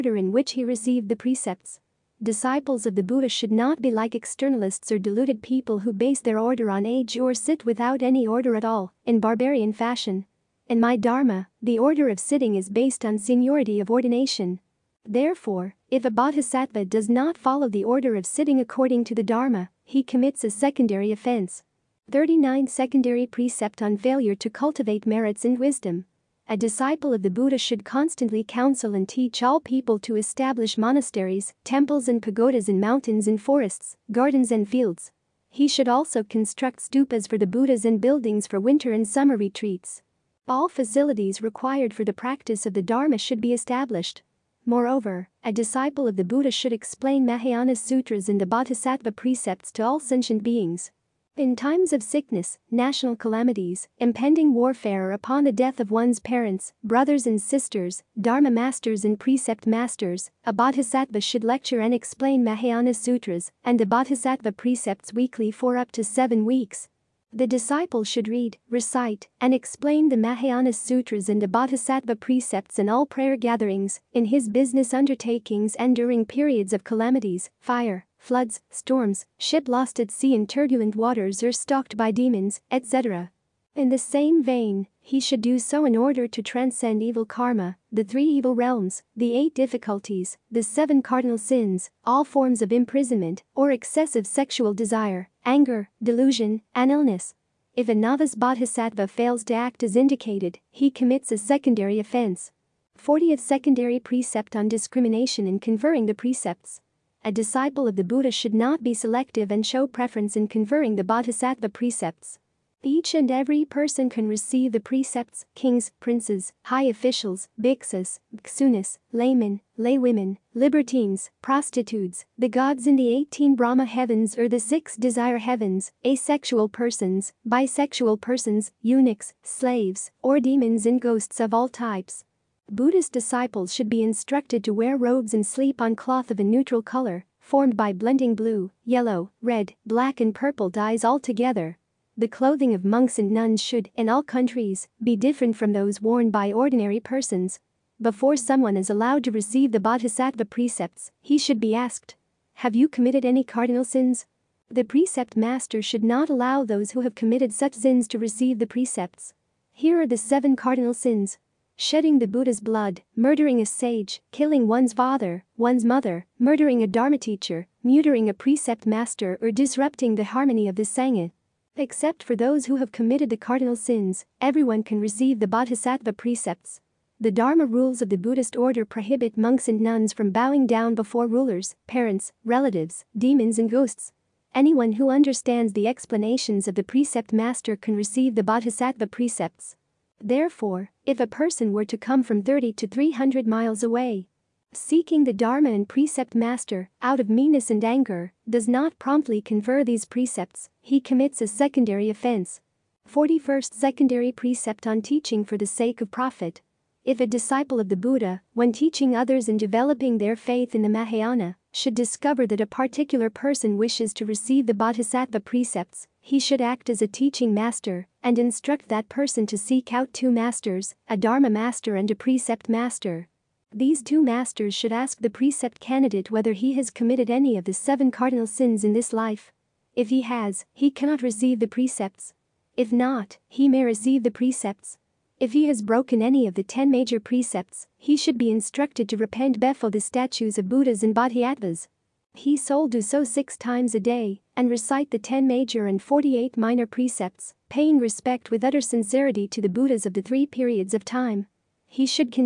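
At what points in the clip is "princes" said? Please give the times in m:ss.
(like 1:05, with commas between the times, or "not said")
1:56.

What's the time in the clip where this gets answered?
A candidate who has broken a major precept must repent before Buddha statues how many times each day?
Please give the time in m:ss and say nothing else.
4:03.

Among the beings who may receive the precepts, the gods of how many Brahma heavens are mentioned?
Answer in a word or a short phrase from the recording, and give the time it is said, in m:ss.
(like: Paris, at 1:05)
18, at 2:03.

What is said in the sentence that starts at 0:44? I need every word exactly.
Moreover, a disciple of the Buddha should explain Mahayana sutras and the Bodhisattva precepts to all sentient beings.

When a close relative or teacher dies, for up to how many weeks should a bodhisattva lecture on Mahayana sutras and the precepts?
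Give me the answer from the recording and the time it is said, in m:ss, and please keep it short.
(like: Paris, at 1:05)
7, at 1:06.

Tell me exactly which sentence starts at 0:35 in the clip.
He should also construct stupas for the Buddhas and buildings for winter and summer retreats.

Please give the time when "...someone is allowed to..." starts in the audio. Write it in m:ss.
2:28.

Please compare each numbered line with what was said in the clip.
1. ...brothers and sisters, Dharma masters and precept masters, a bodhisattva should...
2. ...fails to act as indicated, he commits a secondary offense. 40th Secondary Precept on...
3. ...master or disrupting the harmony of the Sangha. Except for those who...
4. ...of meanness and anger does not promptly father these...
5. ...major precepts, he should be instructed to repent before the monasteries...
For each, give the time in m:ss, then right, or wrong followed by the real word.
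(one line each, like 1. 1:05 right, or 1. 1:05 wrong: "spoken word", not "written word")
1. 0:56 right
2. 1:39 right
3. 2:48 right
4. 3:17 wrong: "confer", not "father"
5. 3:56 wrong: "statues", not "monasteries".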